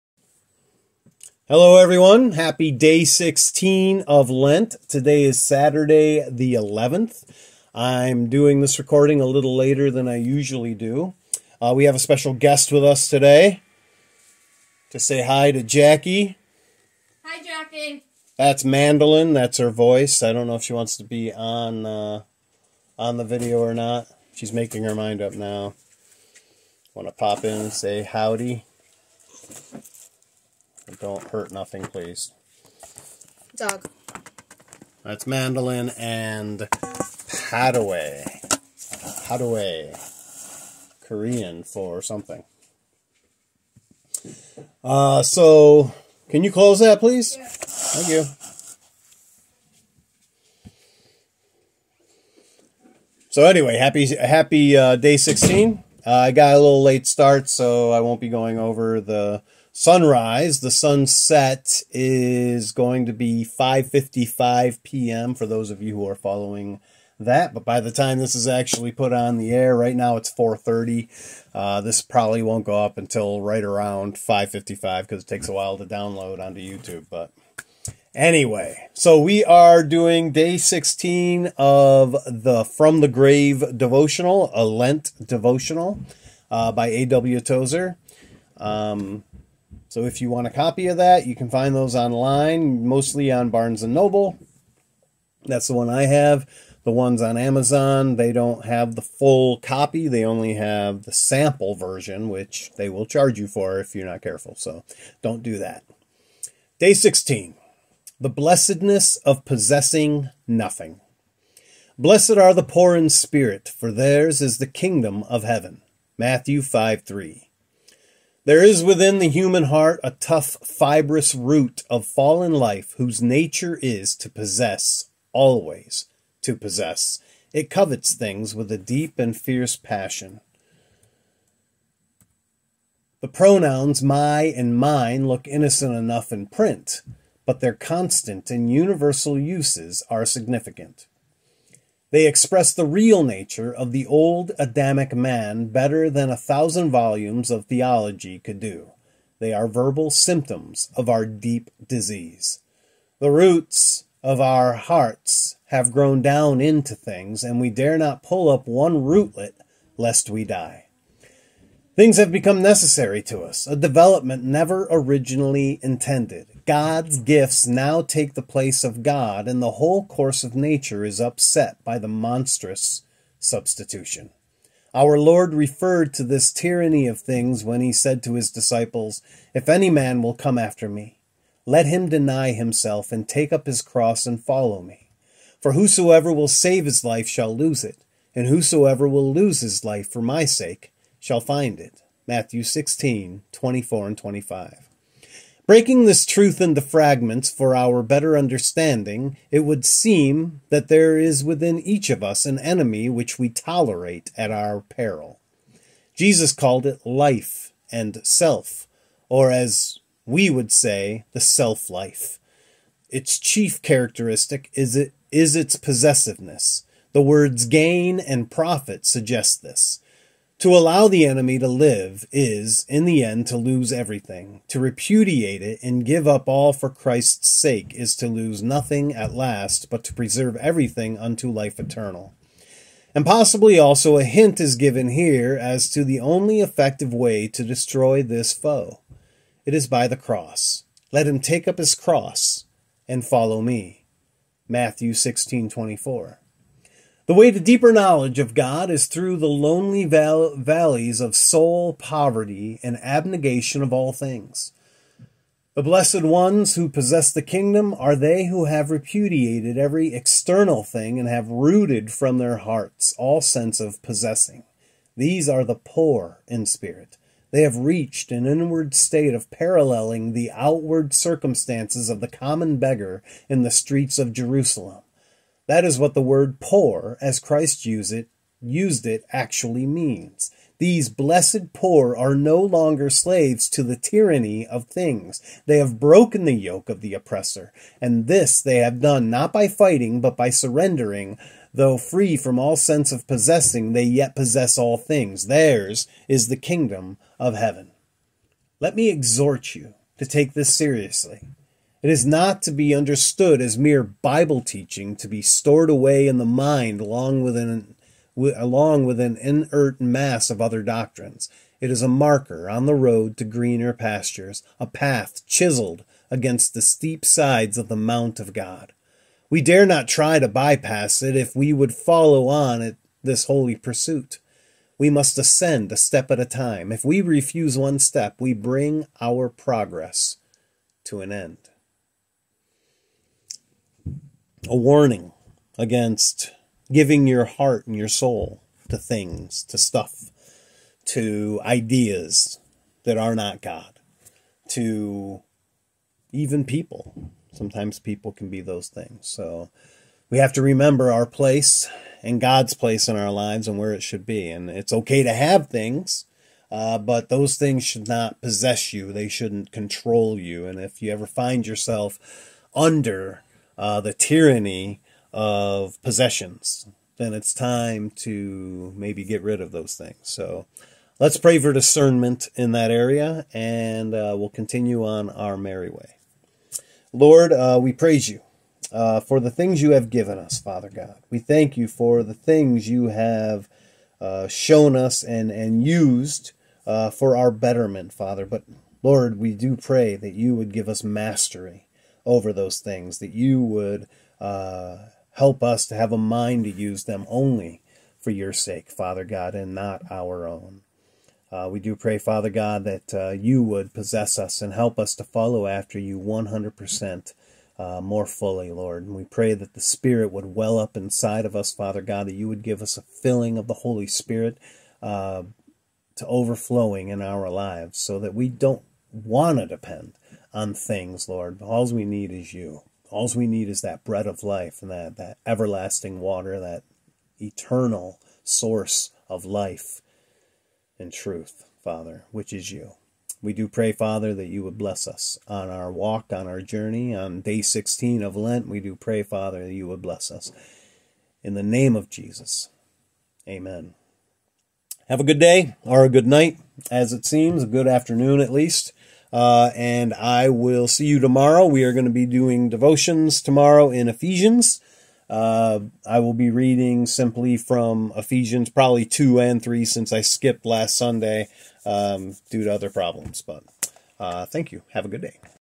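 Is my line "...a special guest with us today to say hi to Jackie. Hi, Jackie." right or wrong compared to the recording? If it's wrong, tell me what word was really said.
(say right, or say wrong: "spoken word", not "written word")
right.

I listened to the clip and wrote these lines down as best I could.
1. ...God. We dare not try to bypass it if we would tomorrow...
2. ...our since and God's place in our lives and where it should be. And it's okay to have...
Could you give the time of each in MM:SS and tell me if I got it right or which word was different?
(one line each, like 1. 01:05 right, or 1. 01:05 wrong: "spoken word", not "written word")
1. 05:18 wrong: "follow", not "tomorrow"
2. 05:51 wrong: "place", not "since".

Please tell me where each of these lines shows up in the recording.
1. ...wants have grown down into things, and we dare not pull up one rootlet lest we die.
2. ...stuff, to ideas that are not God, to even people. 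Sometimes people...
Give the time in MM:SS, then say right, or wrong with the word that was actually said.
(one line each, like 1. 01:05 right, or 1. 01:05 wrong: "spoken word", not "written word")
1. 02:34 wrong: "hearts", not "wants"
2. 05:39 right.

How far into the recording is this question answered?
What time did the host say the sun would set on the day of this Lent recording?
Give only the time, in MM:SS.
01:03.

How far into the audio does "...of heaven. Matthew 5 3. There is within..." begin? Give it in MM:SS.
01:55.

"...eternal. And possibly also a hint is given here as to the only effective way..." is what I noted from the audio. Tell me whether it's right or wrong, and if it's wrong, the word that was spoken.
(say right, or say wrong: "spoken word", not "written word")
right.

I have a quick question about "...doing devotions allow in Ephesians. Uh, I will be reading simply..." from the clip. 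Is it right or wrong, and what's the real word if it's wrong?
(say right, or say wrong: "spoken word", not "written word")
wrong: "tomorrow", not "allow".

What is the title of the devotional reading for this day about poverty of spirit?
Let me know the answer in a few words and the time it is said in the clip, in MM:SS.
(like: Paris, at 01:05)
The blessedness of possessing nothing, at 01:48.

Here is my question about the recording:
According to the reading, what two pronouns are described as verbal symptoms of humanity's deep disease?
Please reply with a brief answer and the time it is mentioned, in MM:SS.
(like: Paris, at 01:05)
my and mine, at 02:14.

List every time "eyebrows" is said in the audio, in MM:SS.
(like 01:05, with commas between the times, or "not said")
not said.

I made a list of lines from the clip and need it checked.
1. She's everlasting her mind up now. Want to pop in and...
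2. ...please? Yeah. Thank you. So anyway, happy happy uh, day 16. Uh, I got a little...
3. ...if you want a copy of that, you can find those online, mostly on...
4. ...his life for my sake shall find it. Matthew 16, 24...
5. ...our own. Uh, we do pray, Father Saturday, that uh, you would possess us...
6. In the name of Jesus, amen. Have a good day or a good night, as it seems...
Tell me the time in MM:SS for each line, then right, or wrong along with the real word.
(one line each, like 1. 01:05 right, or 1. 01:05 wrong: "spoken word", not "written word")
1. 00:24 wrong: "making", not "everlasting"
2. 00:46 right
3. 01:30 right
4. 03:09 right
5. 06:40 wrong: "God", not "Saturday"
6. 07:21 right.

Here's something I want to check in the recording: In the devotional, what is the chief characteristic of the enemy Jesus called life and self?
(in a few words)
possessiveness.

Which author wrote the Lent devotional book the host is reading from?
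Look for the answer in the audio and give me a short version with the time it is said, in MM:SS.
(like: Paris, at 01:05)
A.W. Tozer, at 01:26.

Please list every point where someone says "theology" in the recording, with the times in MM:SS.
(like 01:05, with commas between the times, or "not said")
02:27.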